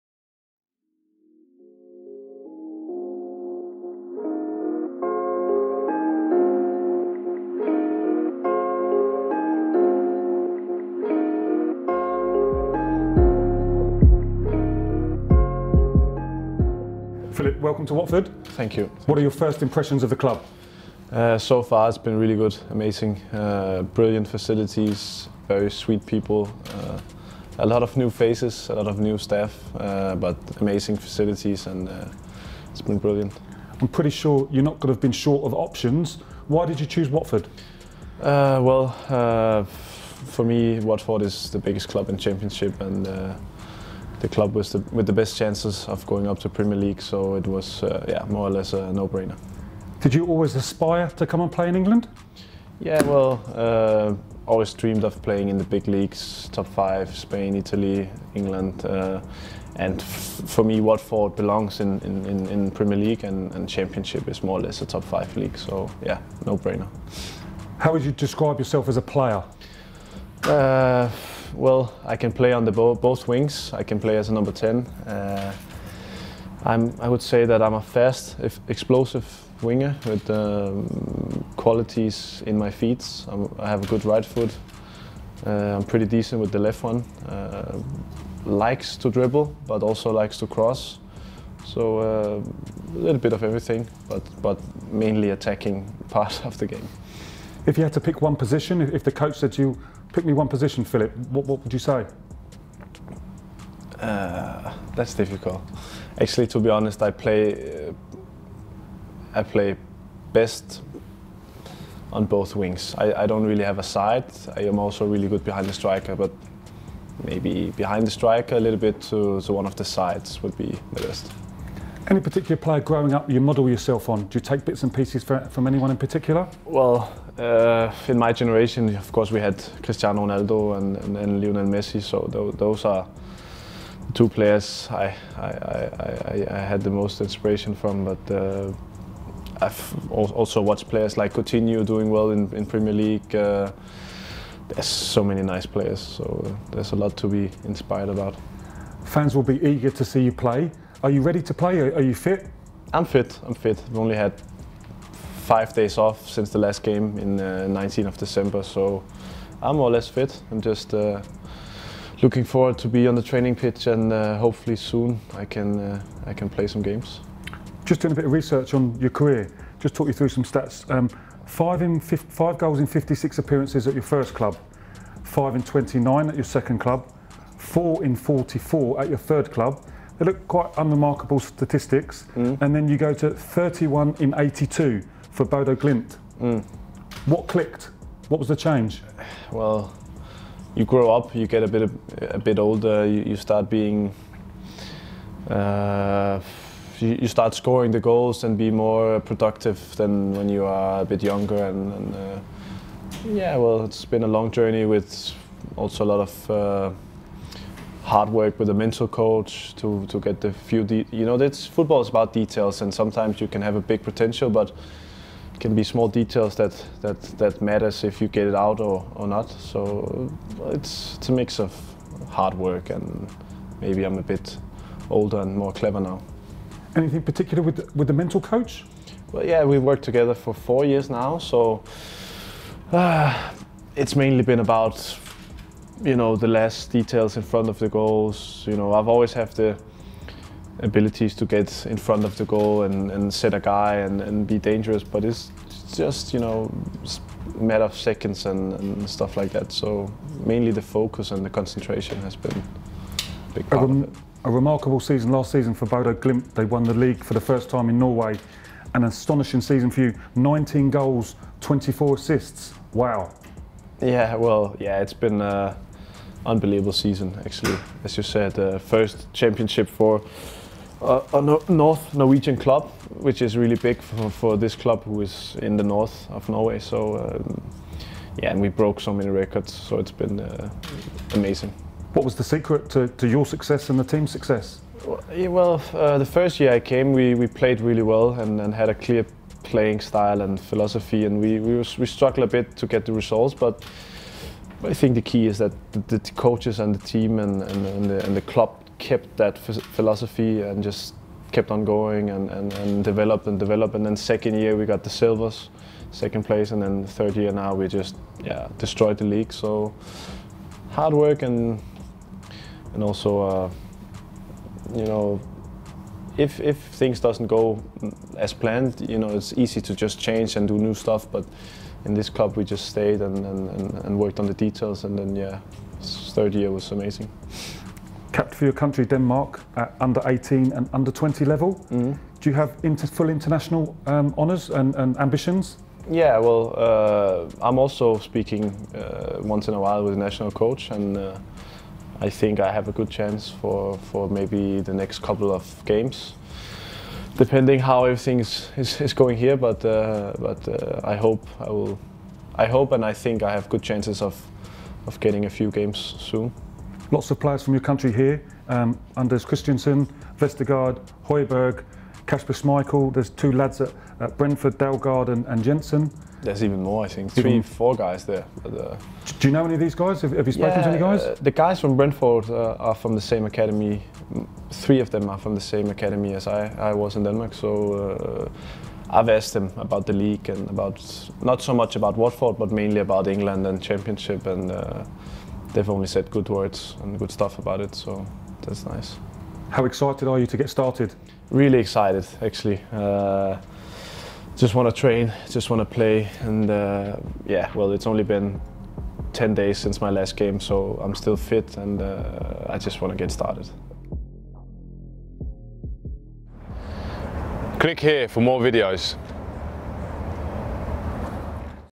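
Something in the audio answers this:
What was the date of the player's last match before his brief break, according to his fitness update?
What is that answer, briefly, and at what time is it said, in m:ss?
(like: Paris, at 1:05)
19th of December, at 2:37.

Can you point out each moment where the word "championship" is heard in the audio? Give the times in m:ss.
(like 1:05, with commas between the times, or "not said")
0:42, 1:03, 4:29, 6:23.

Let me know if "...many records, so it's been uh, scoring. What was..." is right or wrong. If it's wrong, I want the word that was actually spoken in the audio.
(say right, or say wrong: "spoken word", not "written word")
wrong: "amazing", not "scoring".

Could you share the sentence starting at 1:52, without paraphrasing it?
I, I, don't really have a side.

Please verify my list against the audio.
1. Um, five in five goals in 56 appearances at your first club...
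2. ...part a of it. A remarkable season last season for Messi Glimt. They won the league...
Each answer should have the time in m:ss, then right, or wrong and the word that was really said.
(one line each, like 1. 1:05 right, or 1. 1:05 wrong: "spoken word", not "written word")
1. 2:50 right
2. 4:13 wrong: "Bodo", not "Messi".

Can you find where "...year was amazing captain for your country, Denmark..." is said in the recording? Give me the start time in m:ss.
5:26.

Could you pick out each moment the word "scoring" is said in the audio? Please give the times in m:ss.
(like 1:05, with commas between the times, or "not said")
3:17.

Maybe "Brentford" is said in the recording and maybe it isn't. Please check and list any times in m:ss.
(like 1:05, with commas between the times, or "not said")
6:04, 6:11.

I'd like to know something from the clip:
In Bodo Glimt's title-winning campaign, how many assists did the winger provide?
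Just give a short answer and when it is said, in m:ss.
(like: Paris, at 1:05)
24, at 4:21.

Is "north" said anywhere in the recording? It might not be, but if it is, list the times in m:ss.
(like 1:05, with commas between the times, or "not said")
4:31, 4:35.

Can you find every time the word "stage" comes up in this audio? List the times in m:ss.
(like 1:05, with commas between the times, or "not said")
not said.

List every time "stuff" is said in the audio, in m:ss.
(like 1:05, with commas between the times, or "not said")
4:09, 5:20, 6:27.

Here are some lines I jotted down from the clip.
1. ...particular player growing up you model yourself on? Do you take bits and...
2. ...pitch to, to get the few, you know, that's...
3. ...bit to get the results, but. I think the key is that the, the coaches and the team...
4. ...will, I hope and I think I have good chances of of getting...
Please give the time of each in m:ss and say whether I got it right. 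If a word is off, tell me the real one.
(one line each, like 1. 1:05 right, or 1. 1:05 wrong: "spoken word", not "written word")
1. 2:02 right
2. 3:29 wrong: "coach", not "pitch"
3. 4:52 right
4. 5:51 right.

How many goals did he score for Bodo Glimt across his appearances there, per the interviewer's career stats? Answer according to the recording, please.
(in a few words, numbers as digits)
31.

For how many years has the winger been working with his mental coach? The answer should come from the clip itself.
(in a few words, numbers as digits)
4.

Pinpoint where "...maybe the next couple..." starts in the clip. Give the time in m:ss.
5:44.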